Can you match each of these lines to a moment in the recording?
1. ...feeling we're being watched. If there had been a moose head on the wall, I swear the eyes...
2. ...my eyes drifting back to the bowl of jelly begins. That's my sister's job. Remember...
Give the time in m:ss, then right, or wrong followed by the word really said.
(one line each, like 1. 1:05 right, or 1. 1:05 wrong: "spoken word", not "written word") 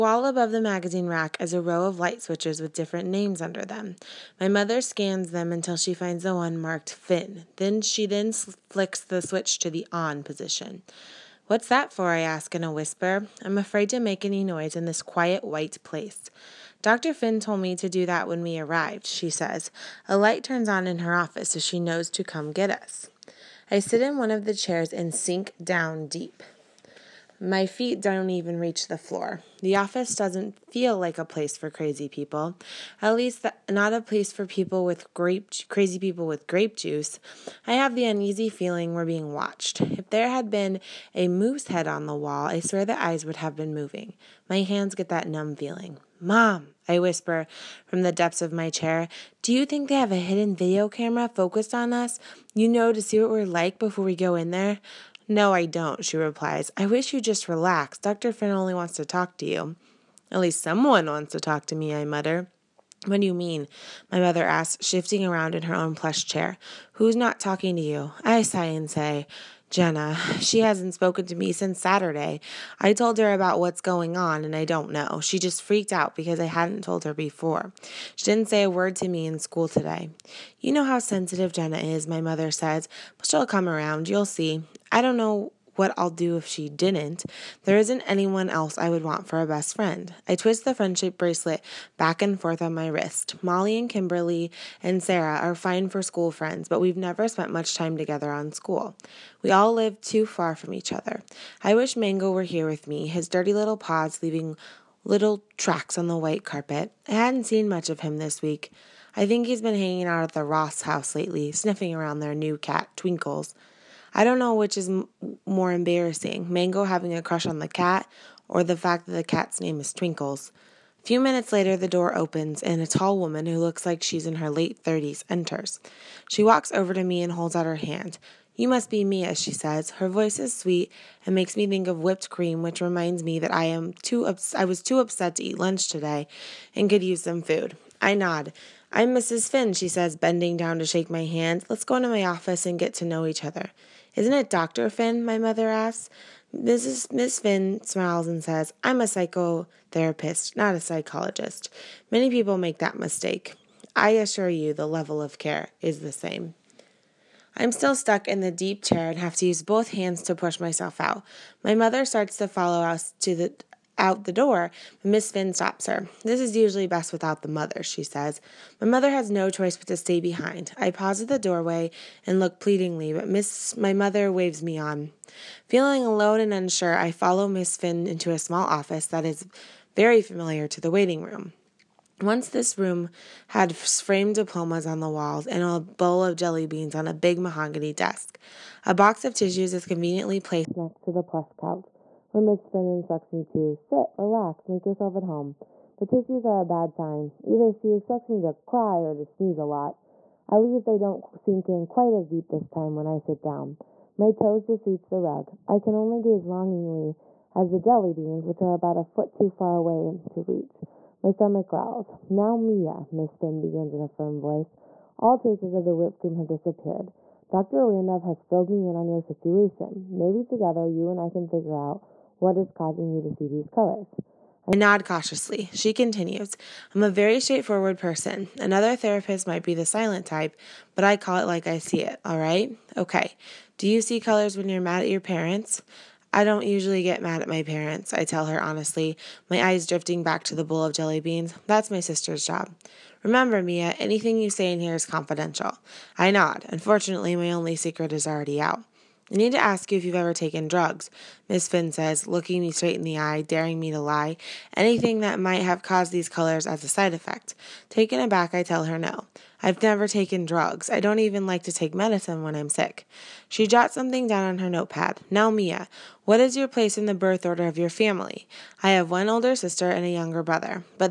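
1. 0:38 right
2. 3:59 wrong: "beans", not "begins".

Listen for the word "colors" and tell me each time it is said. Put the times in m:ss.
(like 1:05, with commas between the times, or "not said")
3:43, 3:54, 4:16.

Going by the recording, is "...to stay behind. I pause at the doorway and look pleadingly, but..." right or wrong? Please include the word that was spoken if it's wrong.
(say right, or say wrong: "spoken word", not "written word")
right.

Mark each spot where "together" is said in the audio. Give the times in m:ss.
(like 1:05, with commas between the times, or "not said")
1:37, 3:40.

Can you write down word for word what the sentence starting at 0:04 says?
My mother scans them until she finds the one marked Finn.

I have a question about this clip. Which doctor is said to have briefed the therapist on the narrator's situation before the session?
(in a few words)
Dr. Randolph.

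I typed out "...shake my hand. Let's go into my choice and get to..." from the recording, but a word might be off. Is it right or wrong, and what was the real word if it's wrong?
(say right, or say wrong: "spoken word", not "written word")
wrong: "office", not "choice".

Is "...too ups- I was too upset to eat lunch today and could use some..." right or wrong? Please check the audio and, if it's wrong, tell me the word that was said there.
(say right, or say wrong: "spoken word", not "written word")
right.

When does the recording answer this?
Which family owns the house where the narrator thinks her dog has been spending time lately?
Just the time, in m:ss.
1:50.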